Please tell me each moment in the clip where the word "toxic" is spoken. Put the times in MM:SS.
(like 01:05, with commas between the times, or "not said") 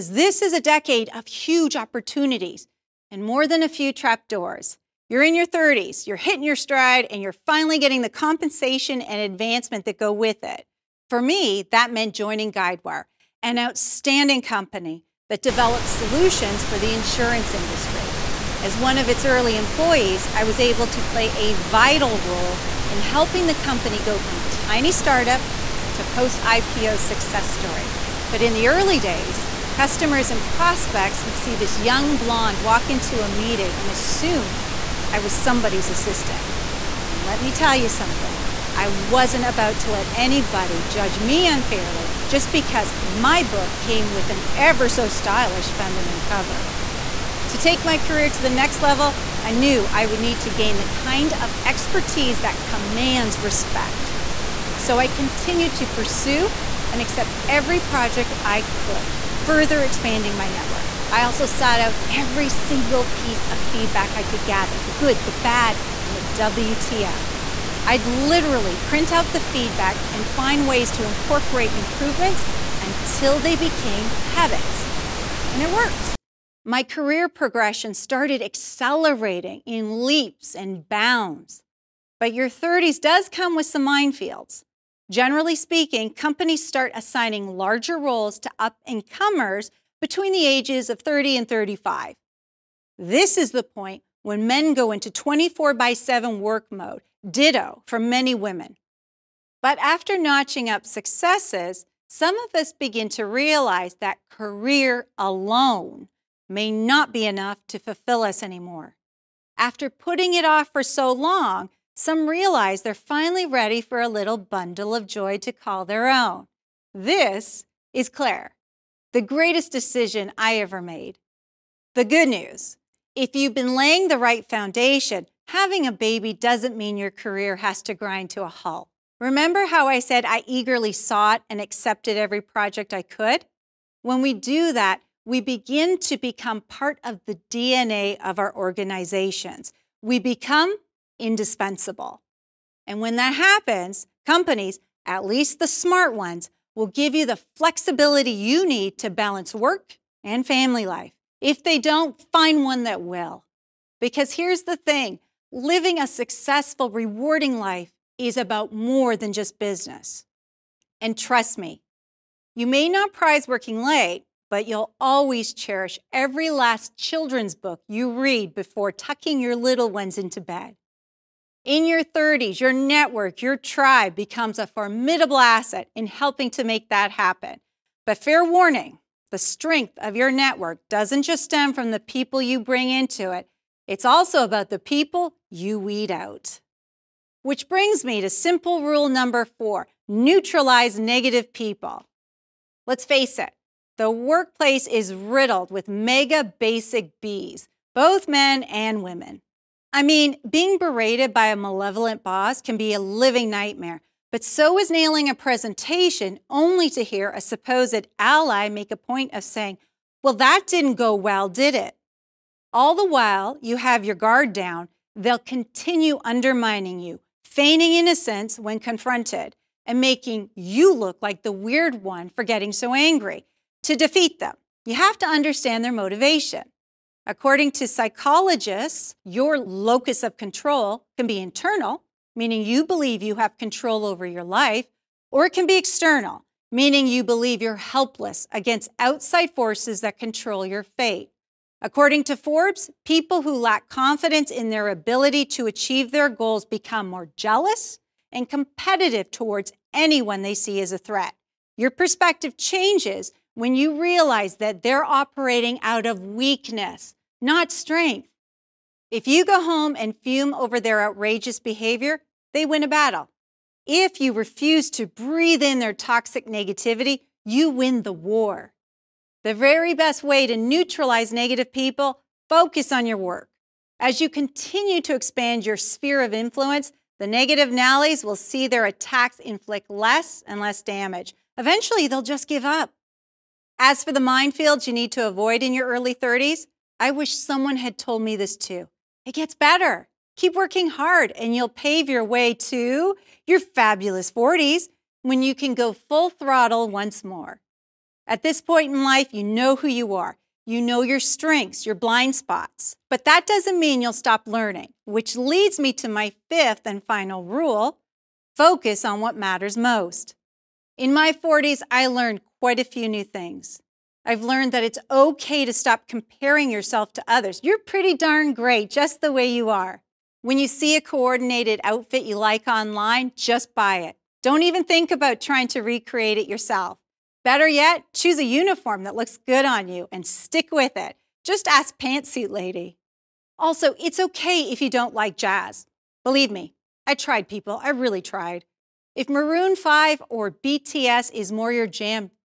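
04:25.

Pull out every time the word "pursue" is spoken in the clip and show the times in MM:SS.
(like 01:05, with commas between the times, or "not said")
00:55.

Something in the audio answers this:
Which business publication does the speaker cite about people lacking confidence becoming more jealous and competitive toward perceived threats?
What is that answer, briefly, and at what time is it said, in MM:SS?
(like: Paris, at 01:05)
Forbes, at 04:02.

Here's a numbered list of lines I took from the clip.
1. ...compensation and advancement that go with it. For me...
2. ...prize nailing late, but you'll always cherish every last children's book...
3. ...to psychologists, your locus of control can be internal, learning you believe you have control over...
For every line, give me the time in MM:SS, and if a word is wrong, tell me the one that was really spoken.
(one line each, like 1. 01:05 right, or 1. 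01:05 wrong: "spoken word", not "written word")
1. 00:08 right
2. 02:43 wrong: "working", not "nailing"
3. 03:47 wrong: "meaning", not "learning".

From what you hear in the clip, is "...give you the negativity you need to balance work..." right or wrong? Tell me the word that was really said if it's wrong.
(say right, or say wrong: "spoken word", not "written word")
wrong: "flexibility", not "negativity".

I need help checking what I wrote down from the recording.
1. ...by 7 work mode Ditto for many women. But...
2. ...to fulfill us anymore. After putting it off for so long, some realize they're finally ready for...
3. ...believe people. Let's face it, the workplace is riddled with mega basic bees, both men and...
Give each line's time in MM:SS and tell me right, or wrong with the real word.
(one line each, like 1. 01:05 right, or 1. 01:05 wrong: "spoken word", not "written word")
1. 01:35 right
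2. 01:47 right
3. 03:10 wrong: "negative", not "believe".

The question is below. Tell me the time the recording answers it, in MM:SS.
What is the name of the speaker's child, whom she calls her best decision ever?
01:58.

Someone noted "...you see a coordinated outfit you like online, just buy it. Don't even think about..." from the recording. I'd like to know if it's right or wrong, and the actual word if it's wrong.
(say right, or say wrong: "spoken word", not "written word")
right.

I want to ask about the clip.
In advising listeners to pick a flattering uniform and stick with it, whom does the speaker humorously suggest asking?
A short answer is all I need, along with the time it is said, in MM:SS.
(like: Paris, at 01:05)
Pantsuit Lady, at 05:31.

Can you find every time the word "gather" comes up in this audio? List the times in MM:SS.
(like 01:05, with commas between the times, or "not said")
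01:04.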